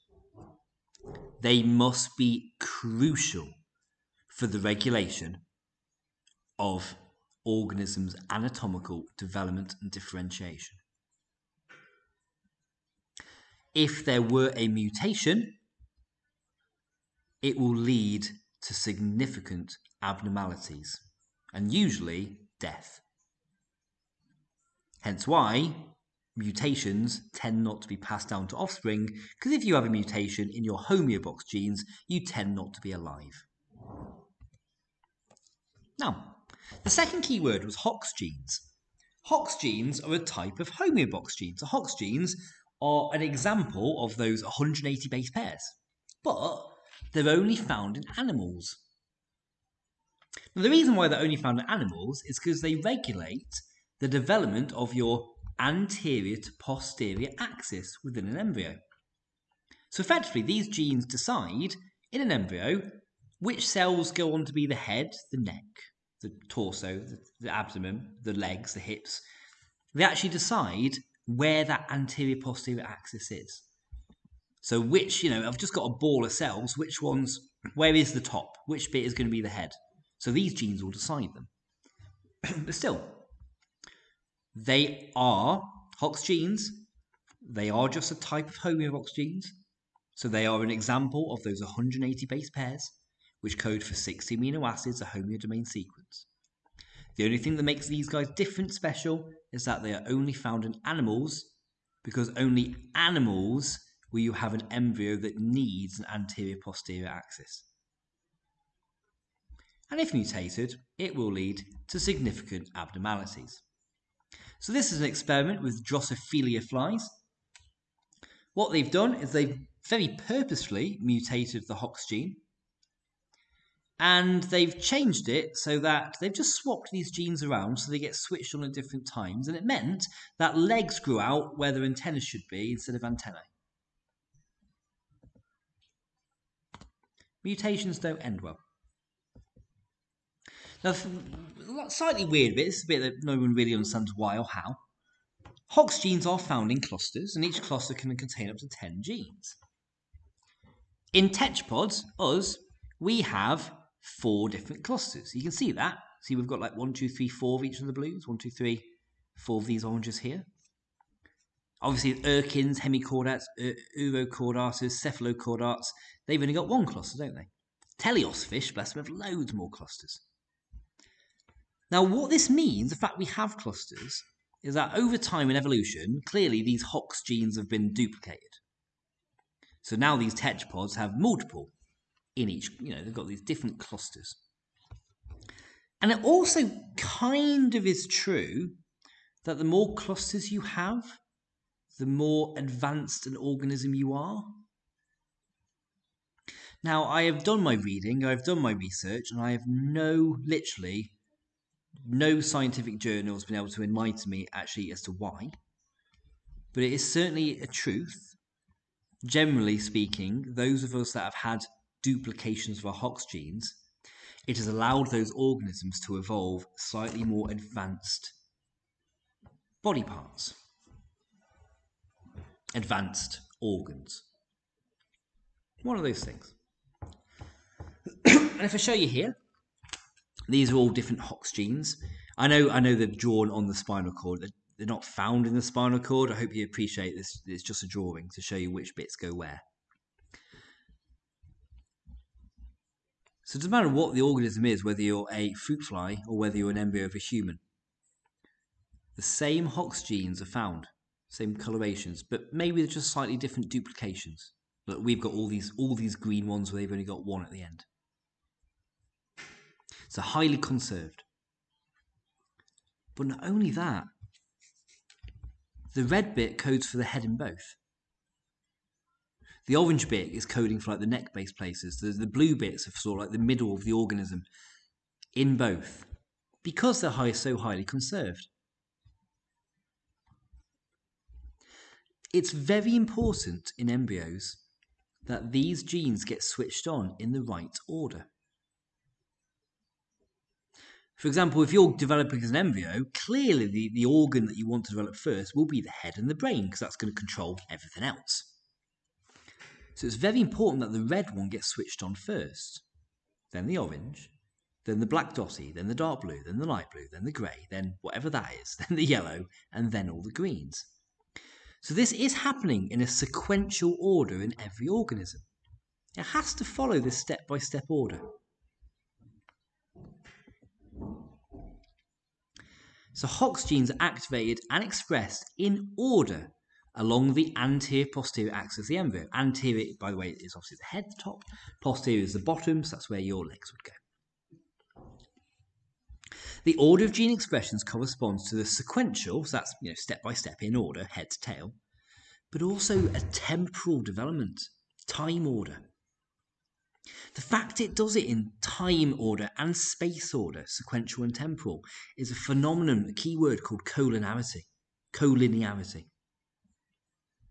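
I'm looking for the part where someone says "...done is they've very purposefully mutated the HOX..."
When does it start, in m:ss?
1:58.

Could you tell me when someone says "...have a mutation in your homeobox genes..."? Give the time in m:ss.
0:29.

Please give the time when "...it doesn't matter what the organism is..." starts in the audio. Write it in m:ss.
4:03.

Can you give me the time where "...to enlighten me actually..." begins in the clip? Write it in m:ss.
3:23.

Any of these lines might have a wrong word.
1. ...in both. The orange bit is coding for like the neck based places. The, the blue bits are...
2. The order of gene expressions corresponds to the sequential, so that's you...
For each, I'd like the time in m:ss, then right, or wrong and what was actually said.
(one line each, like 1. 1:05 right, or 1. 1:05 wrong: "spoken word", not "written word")
1. 4:27 right
2. 5:36 right.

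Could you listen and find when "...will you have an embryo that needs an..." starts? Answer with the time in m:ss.
1:44.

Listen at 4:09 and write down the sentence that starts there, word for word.
The same Hox genes are found, same colorations, but maybe they're just slightly different duplications.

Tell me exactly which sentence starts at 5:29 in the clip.
Anterior, by the way, is obviously the head, the top.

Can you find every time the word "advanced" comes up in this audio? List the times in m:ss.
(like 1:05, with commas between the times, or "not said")
3:12, 3:37, 3:42.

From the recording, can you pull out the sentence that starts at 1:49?
And if mutated, it will lead to significant abnormalities.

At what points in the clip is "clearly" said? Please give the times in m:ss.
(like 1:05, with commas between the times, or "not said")
2:56, 4:53.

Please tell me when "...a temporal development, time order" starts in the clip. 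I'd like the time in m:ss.
5:43.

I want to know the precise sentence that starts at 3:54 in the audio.
They're not found in the spinal cord.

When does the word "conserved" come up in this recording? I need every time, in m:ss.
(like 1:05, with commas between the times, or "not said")
4:20, 4:37.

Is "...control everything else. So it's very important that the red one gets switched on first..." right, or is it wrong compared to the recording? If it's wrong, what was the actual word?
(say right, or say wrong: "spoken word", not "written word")
right.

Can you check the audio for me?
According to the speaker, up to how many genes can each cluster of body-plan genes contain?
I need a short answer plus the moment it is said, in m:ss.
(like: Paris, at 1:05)
10, at 2:28.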